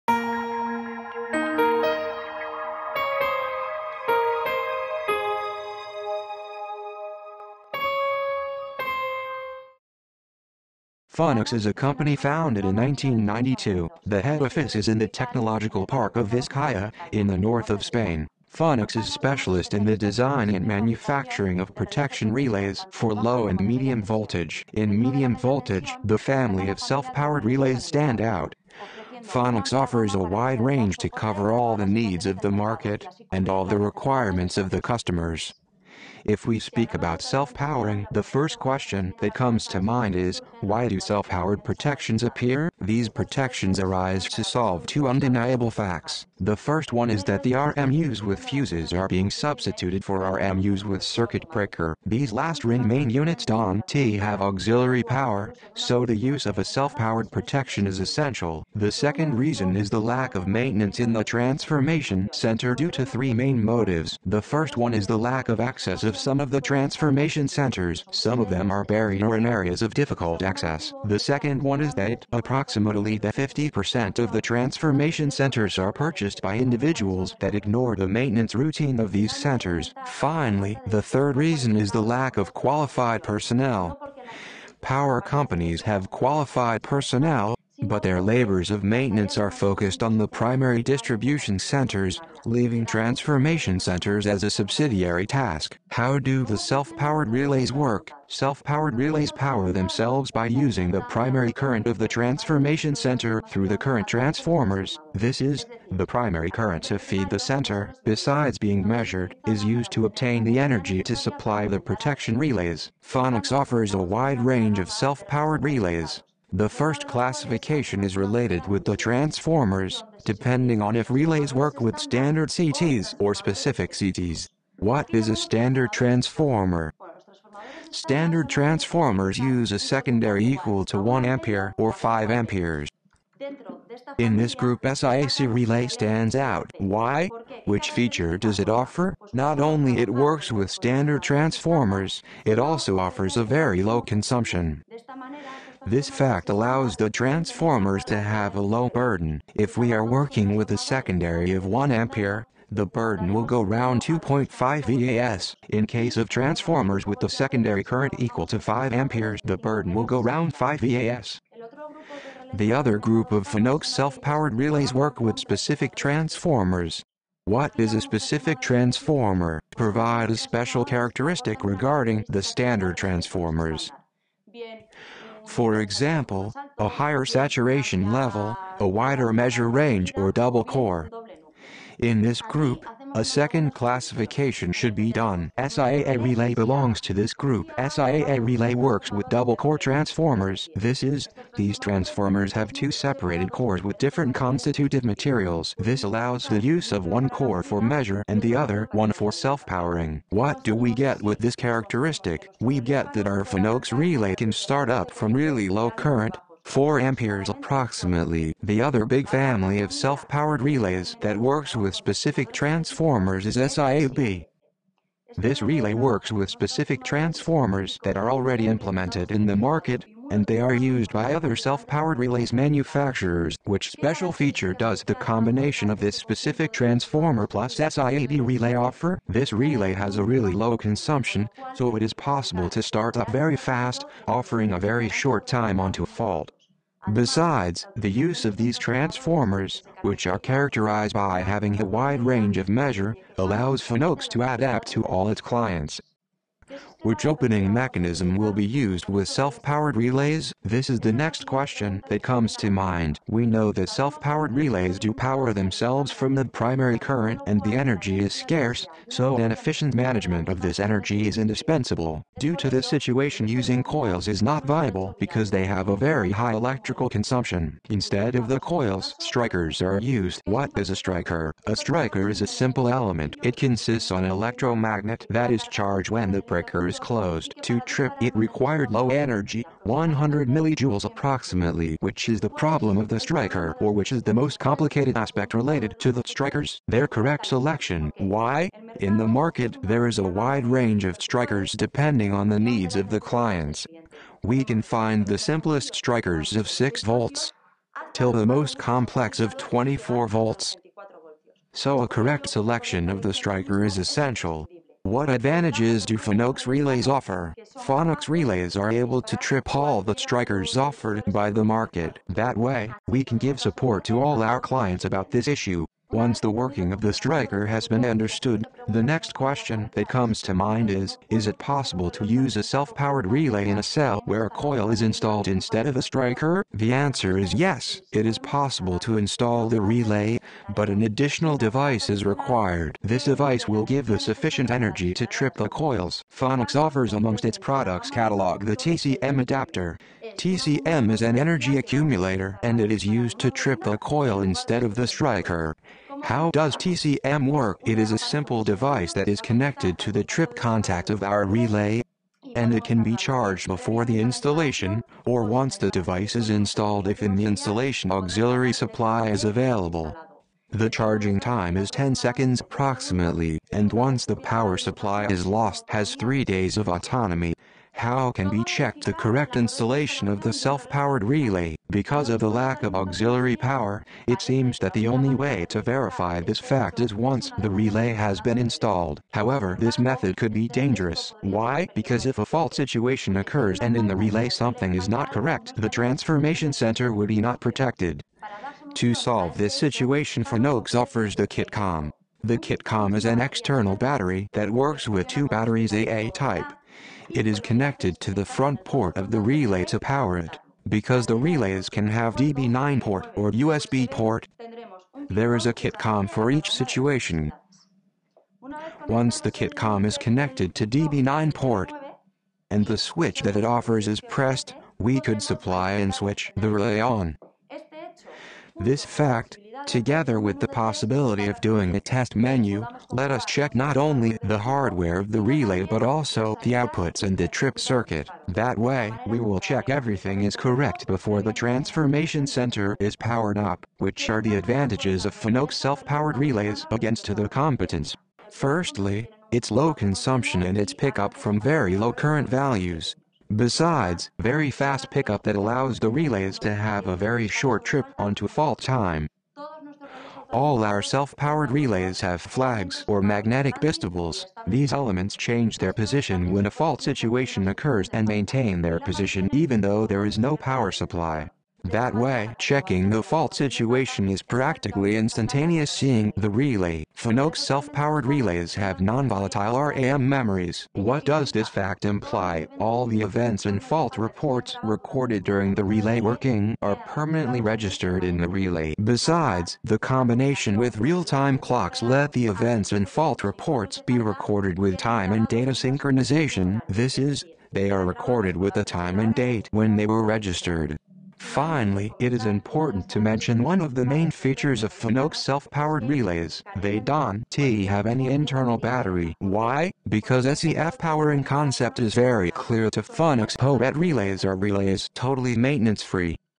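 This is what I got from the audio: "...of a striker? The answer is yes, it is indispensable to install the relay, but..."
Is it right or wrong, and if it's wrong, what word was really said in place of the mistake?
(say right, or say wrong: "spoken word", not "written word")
wrong: "possible", not "indispensable".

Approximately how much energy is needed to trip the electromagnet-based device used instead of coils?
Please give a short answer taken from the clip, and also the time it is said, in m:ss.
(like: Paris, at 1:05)
100 millijoules, at 4:39.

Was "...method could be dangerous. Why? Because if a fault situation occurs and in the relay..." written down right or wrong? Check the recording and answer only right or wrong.
right.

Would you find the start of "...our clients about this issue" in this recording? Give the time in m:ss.
5:14.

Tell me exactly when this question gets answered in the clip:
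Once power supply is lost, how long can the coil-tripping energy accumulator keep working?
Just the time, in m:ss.
6:06.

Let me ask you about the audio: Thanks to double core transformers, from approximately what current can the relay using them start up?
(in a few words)
4 amperes.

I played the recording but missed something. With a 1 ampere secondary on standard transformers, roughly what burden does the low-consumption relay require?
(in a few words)
2.5 VA.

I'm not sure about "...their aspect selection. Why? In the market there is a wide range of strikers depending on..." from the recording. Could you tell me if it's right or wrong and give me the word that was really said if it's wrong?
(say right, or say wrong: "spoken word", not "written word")
wrong: "correct", not "aspect".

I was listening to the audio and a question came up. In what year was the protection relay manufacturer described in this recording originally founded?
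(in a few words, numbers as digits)
1992.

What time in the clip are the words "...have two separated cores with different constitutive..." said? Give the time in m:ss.
3:12.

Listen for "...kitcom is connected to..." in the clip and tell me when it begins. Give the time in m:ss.
6:49.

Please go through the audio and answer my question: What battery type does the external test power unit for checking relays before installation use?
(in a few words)
AA.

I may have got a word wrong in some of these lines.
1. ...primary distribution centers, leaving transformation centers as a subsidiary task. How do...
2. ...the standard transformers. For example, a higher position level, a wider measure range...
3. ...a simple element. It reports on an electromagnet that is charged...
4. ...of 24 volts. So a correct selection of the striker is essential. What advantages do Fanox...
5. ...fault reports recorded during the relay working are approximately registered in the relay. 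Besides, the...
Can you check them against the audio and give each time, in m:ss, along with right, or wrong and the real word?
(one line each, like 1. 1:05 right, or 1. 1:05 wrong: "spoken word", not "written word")
1. 1:30 right
2. 2:52 wrong: "saturation", not "position"
3. 4:32 wrong: "consists", not "reports"
4. 4:59 right
5. 7:53 wrong: "permanently", not "approximately".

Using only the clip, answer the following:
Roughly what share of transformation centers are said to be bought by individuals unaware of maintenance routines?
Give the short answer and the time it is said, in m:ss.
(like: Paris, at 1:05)
50%, at 1:13.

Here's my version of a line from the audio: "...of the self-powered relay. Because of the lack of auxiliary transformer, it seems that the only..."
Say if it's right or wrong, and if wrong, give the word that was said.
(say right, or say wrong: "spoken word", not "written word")
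wrong: "power", not "transformer".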